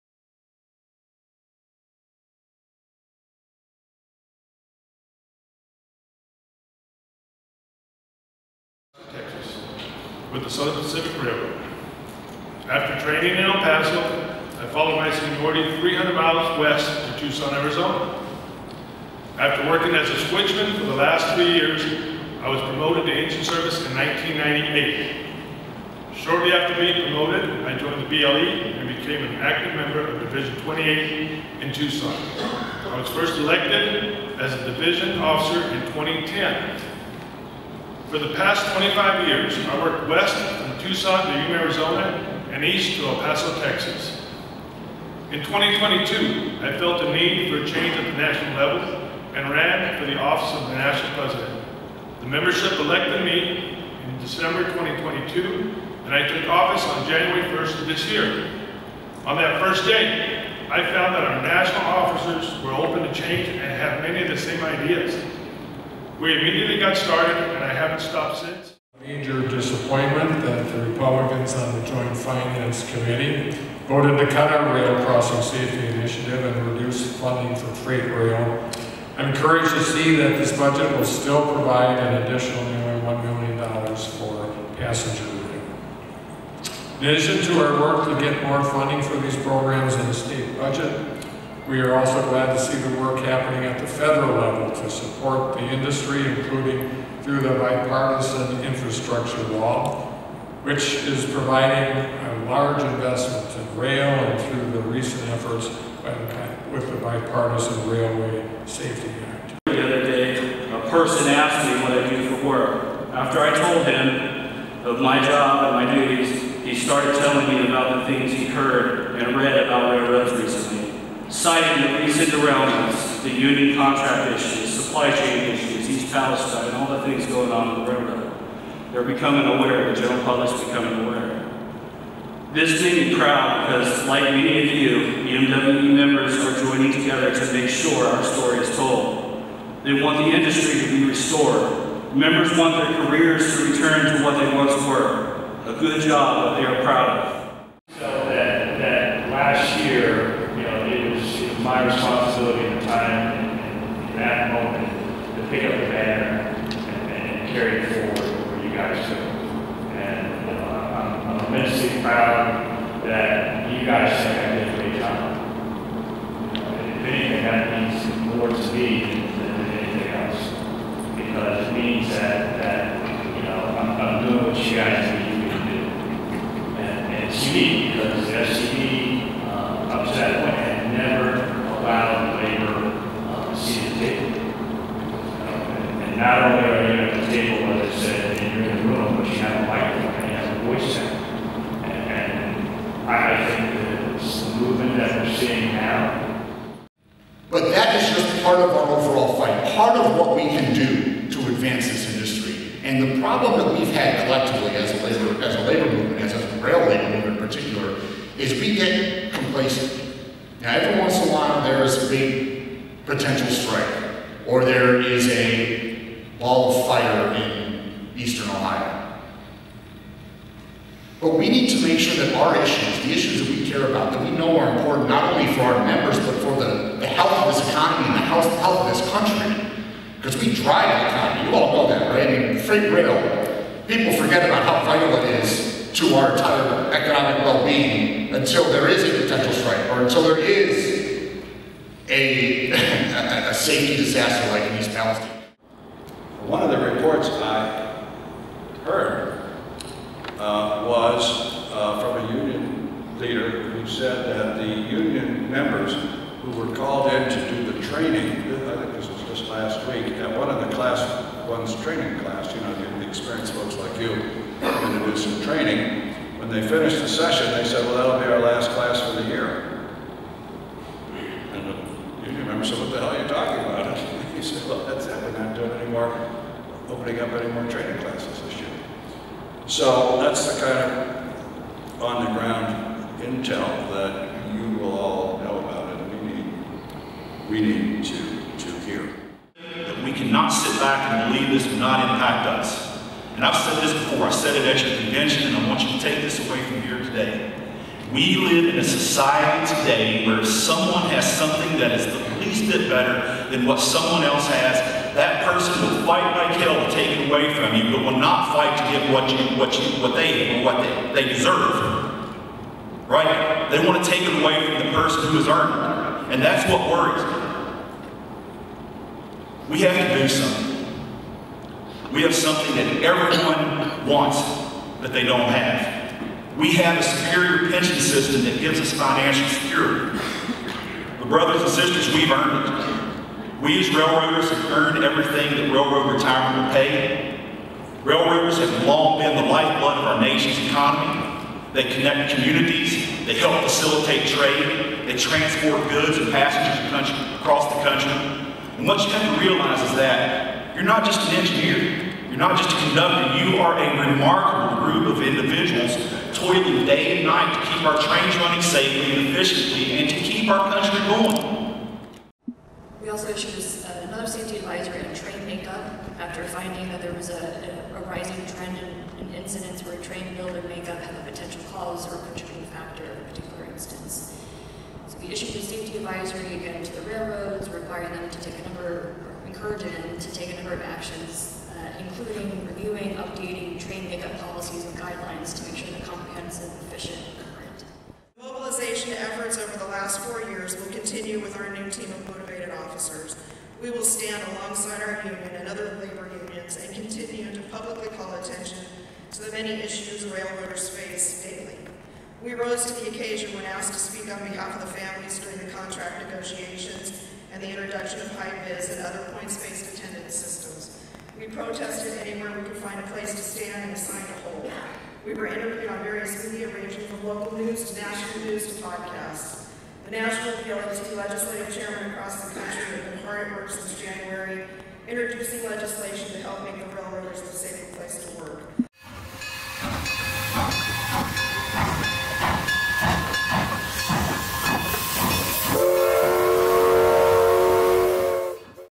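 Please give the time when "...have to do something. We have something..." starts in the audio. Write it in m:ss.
5:19.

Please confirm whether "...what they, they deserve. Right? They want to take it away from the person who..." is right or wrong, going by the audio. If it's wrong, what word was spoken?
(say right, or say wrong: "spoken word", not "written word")
right.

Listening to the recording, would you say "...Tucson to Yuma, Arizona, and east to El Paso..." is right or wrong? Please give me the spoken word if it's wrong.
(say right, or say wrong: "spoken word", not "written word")
right.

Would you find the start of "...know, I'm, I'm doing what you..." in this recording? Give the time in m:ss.
2:53.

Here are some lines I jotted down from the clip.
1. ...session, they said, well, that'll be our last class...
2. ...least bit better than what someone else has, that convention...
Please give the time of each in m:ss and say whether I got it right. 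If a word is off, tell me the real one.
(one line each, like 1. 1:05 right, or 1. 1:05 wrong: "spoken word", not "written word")
1. 4:27 right
2. 5:02 wrong: "person", not "convention".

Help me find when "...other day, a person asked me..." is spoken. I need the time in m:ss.
1:49.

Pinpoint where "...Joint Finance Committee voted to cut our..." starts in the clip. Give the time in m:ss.
1:11.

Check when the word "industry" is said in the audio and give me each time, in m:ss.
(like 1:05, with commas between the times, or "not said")
1:35, 2:20, 3:22.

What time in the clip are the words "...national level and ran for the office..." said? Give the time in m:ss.
0:48.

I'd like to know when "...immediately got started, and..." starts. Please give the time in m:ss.
1:06.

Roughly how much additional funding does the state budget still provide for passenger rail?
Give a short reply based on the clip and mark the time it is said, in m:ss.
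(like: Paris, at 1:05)
$1 million, at 1:23.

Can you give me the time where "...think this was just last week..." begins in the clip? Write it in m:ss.
4:18.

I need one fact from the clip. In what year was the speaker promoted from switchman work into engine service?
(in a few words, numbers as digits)
1998.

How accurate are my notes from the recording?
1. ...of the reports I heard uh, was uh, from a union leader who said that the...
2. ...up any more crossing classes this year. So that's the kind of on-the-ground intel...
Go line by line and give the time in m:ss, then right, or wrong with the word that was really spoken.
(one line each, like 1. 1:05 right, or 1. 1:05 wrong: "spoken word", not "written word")
1. 4:06 right
2. 4:37 wrong: "training", not "crossing".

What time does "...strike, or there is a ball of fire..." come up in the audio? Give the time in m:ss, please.
3:33.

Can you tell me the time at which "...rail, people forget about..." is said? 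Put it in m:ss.
3:52.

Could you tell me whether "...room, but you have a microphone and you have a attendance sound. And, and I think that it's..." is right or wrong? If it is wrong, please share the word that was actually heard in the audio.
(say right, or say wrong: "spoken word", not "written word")
wrong: "voice", not "attendance".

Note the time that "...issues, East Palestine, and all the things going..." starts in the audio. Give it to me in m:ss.
2:05.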